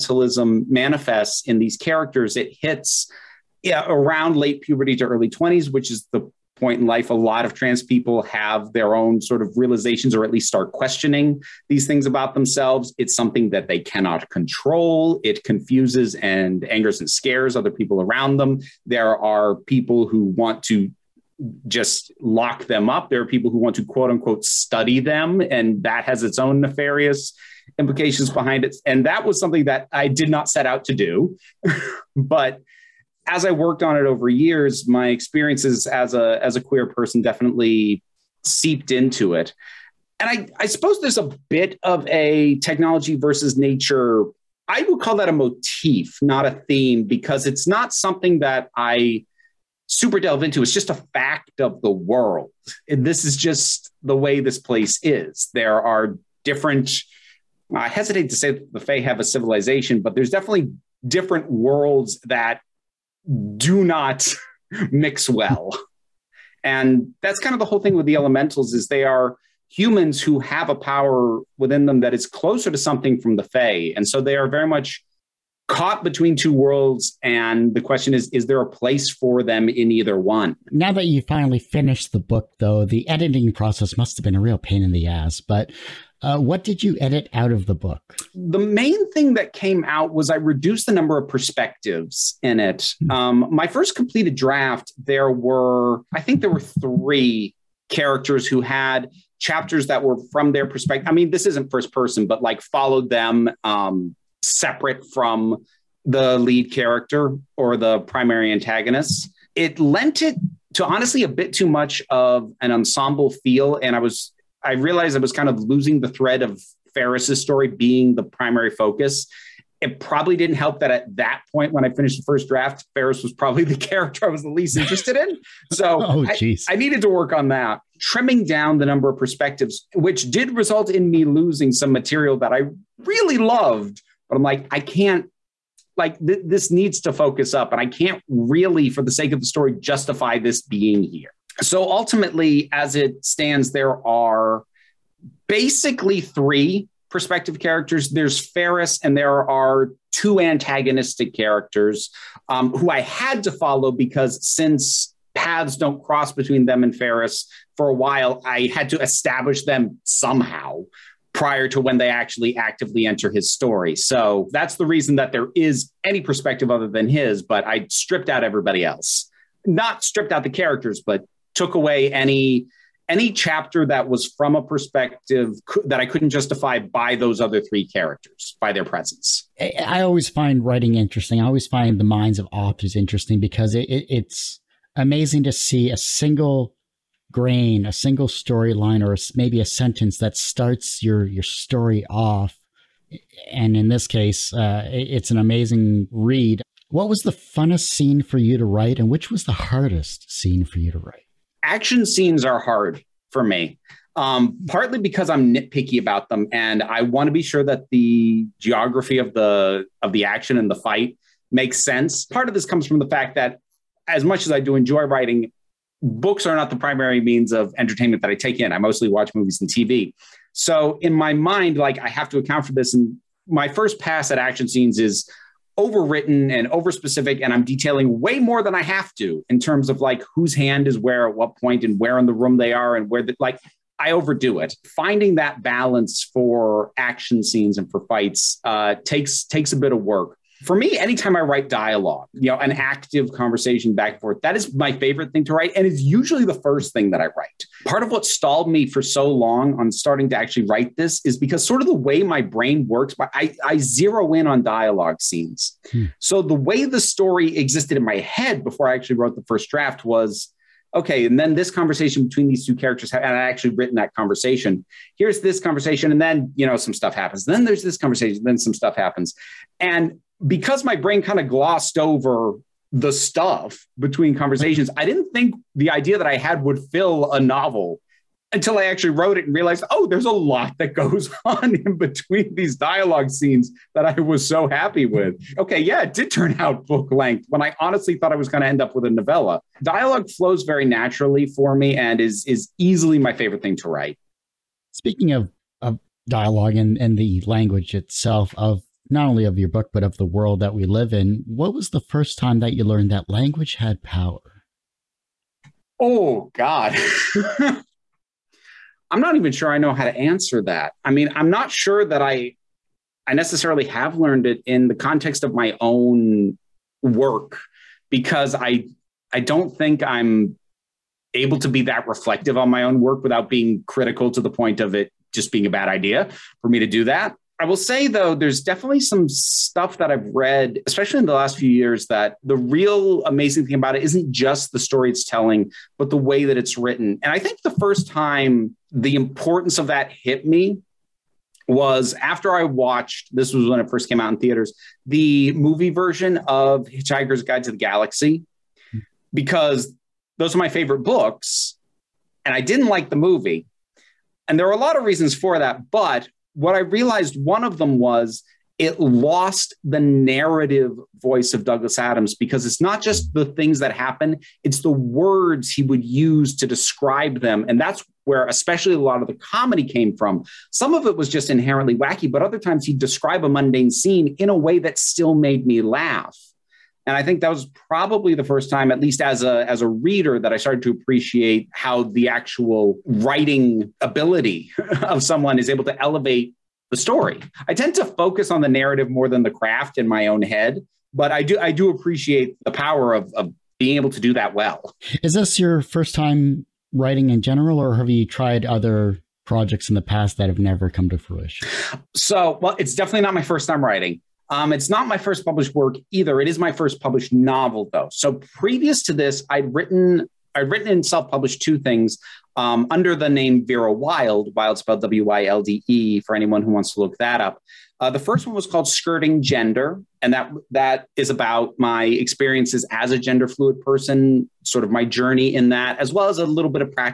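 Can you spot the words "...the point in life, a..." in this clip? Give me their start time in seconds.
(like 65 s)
6 s.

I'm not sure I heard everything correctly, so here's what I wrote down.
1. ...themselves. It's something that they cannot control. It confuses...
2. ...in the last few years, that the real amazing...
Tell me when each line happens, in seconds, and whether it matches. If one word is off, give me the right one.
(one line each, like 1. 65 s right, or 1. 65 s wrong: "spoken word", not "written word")
1. 12 s right
2. 331 s right.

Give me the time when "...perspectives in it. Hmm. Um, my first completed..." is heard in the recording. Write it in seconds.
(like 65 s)
91 s.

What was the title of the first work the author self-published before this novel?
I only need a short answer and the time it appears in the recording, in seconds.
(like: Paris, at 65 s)
Skirting Gender, at 418 s.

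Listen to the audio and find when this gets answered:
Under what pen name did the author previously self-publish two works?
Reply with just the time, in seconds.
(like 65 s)
413 s.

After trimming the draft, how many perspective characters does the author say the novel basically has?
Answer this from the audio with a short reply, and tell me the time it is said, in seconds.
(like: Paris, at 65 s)
3, at 146 s.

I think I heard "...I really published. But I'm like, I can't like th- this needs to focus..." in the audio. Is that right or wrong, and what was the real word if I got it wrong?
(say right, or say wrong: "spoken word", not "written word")
wrong: "loved", not "published".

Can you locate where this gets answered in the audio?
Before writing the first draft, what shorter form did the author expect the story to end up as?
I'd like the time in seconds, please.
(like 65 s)
289 s.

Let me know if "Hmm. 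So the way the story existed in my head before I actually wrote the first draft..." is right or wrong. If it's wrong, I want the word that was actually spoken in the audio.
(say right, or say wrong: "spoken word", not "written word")
right.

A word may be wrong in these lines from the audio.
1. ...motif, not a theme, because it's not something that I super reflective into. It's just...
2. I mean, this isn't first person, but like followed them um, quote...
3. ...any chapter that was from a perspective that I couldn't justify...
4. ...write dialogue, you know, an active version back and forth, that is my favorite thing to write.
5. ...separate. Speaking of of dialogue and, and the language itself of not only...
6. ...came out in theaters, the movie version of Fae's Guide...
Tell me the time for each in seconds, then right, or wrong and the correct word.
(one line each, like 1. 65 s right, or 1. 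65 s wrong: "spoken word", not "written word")
1. 45 s wrong: "delve", not "reflective"
2. 101 s wrong: "separate", not "quote"
3. 173 s right
4. 241 s wrong: "conversation", not "version"
5. 293 s wrong: "write", not "separate"
6. 344 s wrong: "Hitchhiker", not "Fae".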